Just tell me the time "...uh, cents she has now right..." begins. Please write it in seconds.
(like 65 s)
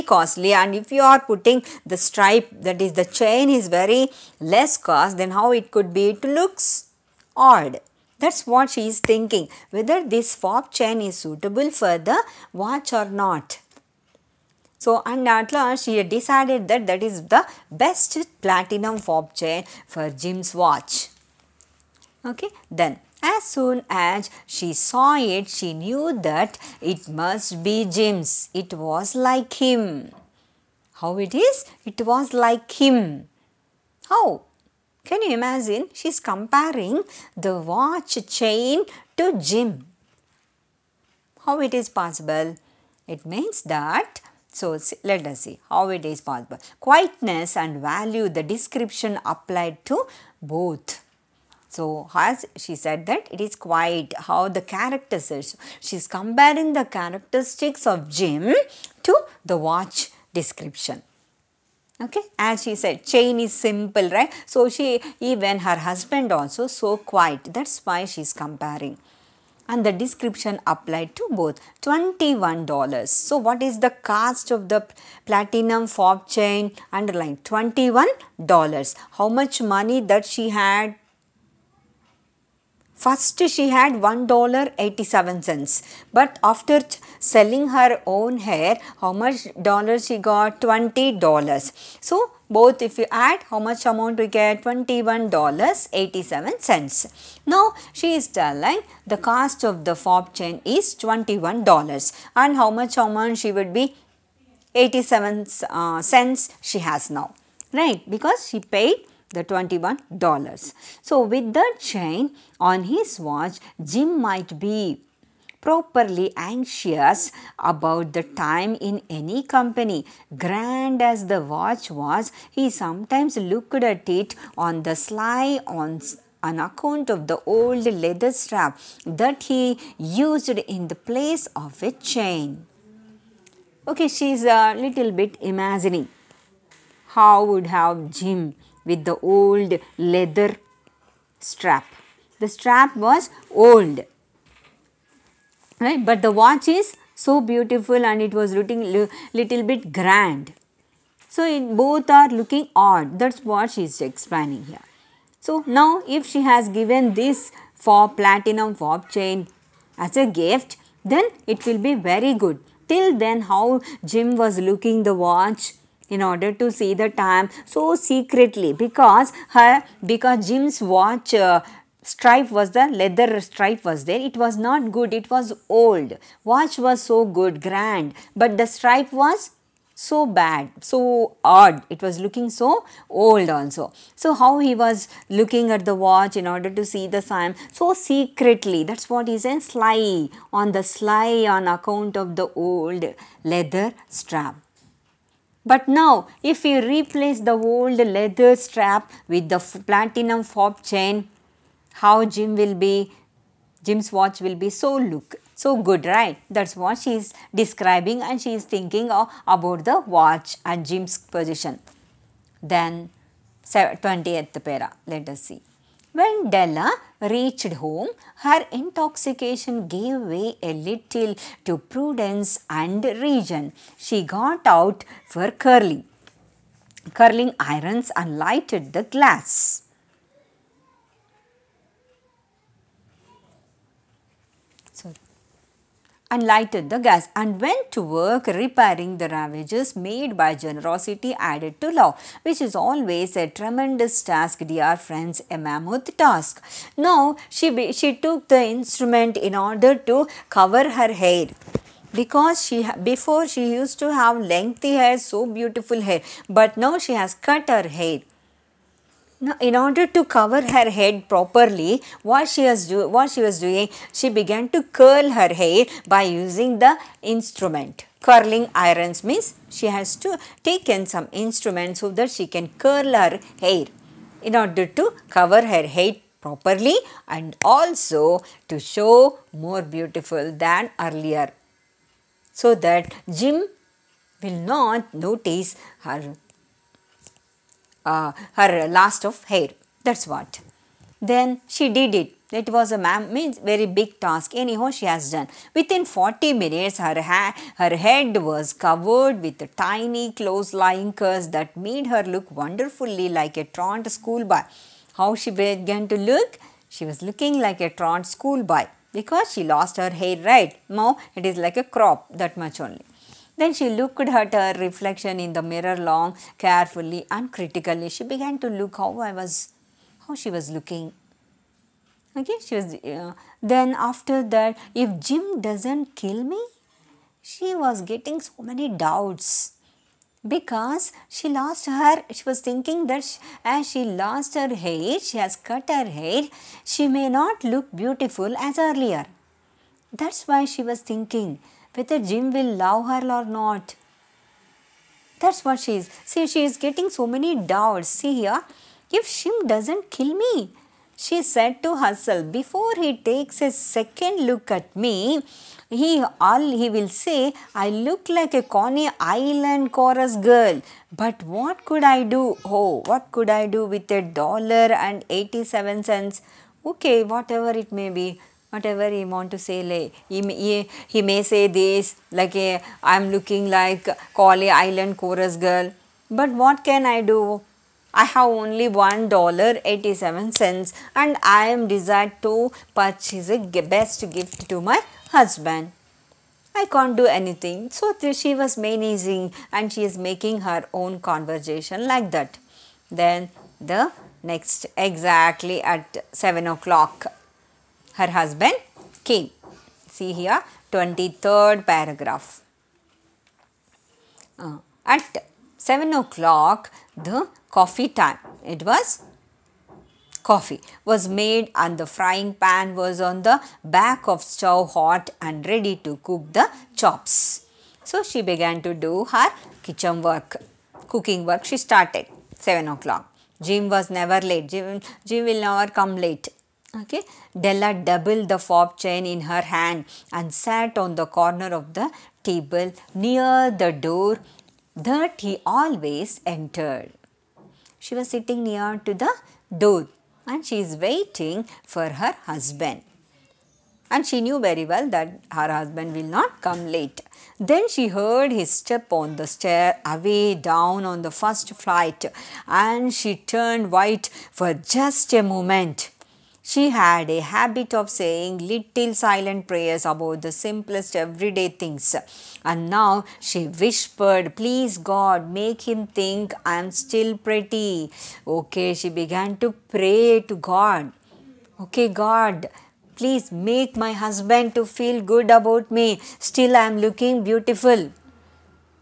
105 s.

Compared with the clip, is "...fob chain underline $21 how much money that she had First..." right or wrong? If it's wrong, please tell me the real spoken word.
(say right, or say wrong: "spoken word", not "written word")
right.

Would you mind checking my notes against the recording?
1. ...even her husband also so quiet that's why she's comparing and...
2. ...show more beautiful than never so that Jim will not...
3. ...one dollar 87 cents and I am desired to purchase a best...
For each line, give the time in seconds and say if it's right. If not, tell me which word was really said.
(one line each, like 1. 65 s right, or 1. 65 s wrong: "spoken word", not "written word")
1. 65 s right
2. 278 s wrong: "earlier", not "never"
3. 378 s right.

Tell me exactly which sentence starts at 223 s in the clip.
She got out for curling, curling irons and lighted the glass.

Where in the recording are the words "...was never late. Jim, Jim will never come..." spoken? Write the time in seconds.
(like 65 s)
423 s.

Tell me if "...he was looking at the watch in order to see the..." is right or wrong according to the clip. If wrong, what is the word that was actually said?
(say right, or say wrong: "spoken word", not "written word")
right.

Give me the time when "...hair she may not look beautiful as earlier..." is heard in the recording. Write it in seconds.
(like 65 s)
336 s.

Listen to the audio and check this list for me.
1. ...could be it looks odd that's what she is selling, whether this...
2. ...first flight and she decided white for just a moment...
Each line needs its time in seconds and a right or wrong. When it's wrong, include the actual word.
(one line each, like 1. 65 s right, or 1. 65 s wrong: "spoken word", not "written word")
1. 5 s wrong: "thinking", not "selling"
2. 451 s wrong: "turned", not "decided".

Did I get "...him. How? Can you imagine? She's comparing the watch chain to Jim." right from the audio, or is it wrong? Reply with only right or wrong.
right.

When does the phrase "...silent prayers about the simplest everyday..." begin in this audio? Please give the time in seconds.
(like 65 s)
459 s.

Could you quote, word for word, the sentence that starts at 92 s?
So both if you add how much amount we get $21.87.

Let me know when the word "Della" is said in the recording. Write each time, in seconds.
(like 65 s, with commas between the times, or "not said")
216 s, 427 s.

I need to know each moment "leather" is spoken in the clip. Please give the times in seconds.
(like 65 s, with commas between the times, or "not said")
127 s, 139 s, 173 s, 193 s, 197 s.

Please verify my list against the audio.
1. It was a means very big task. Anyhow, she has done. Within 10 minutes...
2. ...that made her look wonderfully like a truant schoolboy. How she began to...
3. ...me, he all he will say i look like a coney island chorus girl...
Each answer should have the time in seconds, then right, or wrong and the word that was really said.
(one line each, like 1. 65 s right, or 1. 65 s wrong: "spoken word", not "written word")
1. 292 s wrong: "40", not "10"
2. 301 s right
3. 354 s right.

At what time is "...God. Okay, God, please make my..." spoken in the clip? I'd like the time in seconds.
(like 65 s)
470 s.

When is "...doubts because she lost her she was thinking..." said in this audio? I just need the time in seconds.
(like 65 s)
328 s.